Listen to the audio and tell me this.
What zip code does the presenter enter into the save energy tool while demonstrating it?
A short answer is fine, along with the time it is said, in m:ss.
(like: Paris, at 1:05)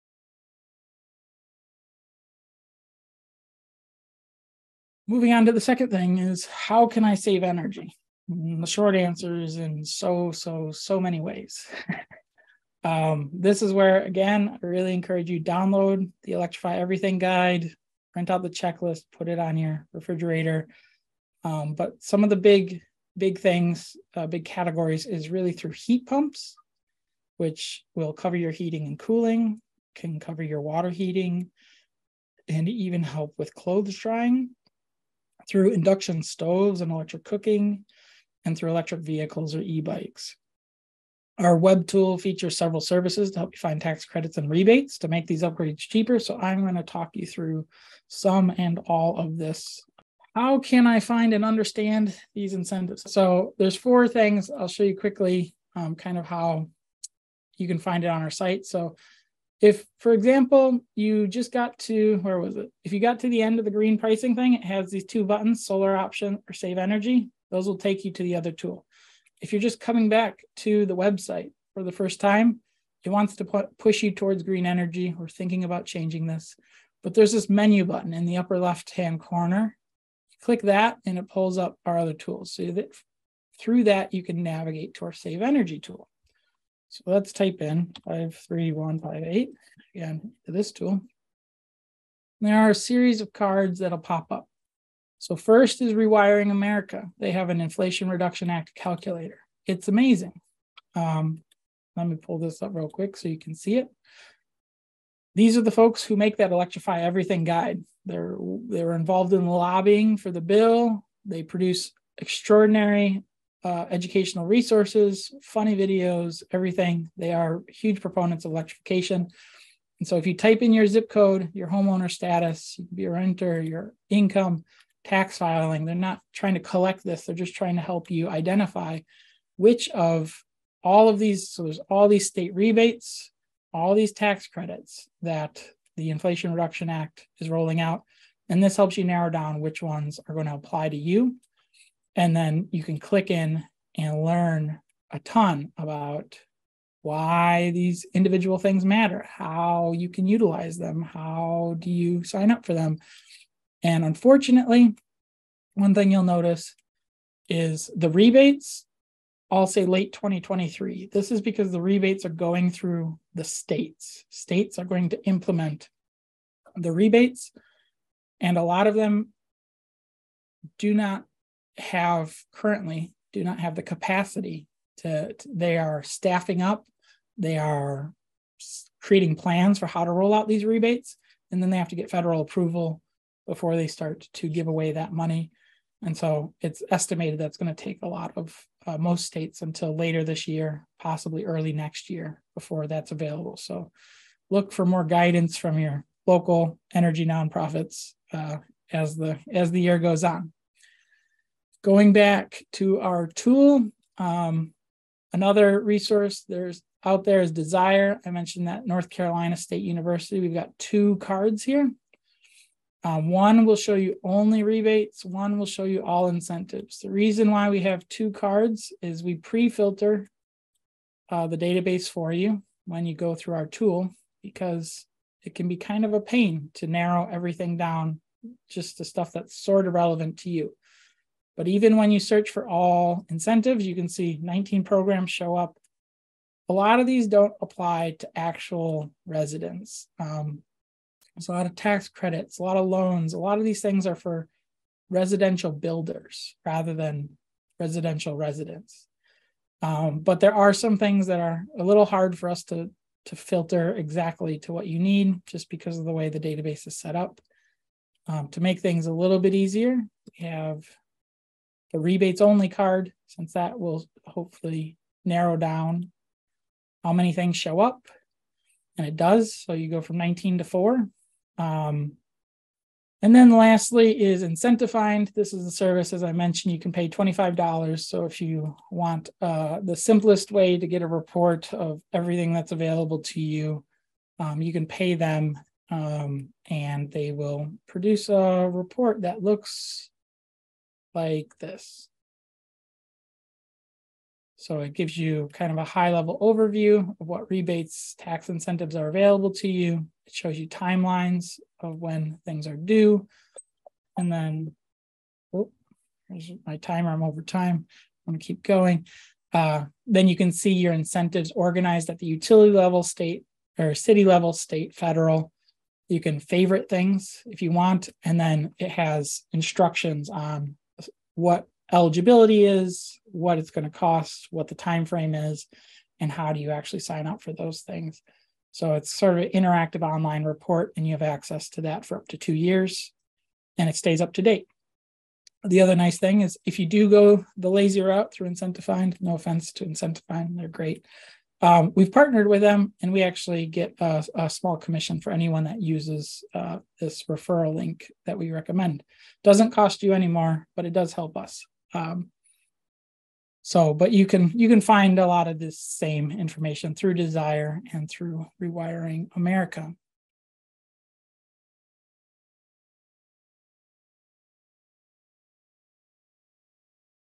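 53158, at 1:28.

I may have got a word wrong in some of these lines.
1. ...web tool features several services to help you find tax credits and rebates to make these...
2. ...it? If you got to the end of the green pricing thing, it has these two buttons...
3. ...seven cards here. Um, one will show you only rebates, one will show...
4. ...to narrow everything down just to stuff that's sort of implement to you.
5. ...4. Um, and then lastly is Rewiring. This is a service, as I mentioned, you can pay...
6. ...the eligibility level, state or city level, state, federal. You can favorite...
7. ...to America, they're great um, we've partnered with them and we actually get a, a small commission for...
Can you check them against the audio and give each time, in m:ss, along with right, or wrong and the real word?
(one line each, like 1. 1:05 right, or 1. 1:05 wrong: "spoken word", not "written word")
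1. 0:41 right
2. 1:02 right
3. 3:30 wrong: "two", not "seven"
4. 3:46 wrong: "relevant", not "implement"
5. 4:30 wrong: "Incentifind", not "Rewiring"
6. 5:12 wrong: "utility", not "eligibility"
7. 5:39 wrong: "Incentifind", not "America".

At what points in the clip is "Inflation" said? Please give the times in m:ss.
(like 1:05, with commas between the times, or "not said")
1:37, 2:16.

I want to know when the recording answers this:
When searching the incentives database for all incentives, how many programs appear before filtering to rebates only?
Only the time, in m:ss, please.
3:54.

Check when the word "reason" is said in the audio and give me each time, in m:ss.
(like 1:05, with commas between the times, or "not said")
3:37.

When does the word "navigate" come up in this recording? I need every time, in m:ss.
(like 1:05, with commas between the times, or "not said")
1:24.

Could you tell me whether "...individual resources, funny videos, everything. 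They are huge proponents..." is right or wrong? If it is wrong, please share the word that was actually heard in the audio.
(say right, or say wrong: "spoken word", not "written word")
wrong: "educational", not "individual".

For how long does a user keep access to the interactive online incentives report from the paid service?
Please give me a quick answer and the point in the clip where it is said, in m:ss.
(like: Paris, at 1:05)
2 years, at 5:32.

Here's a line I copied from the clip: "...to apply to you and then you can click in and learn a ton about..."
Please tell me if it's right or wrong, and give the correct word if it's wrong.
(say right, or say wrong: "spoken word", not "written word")
right.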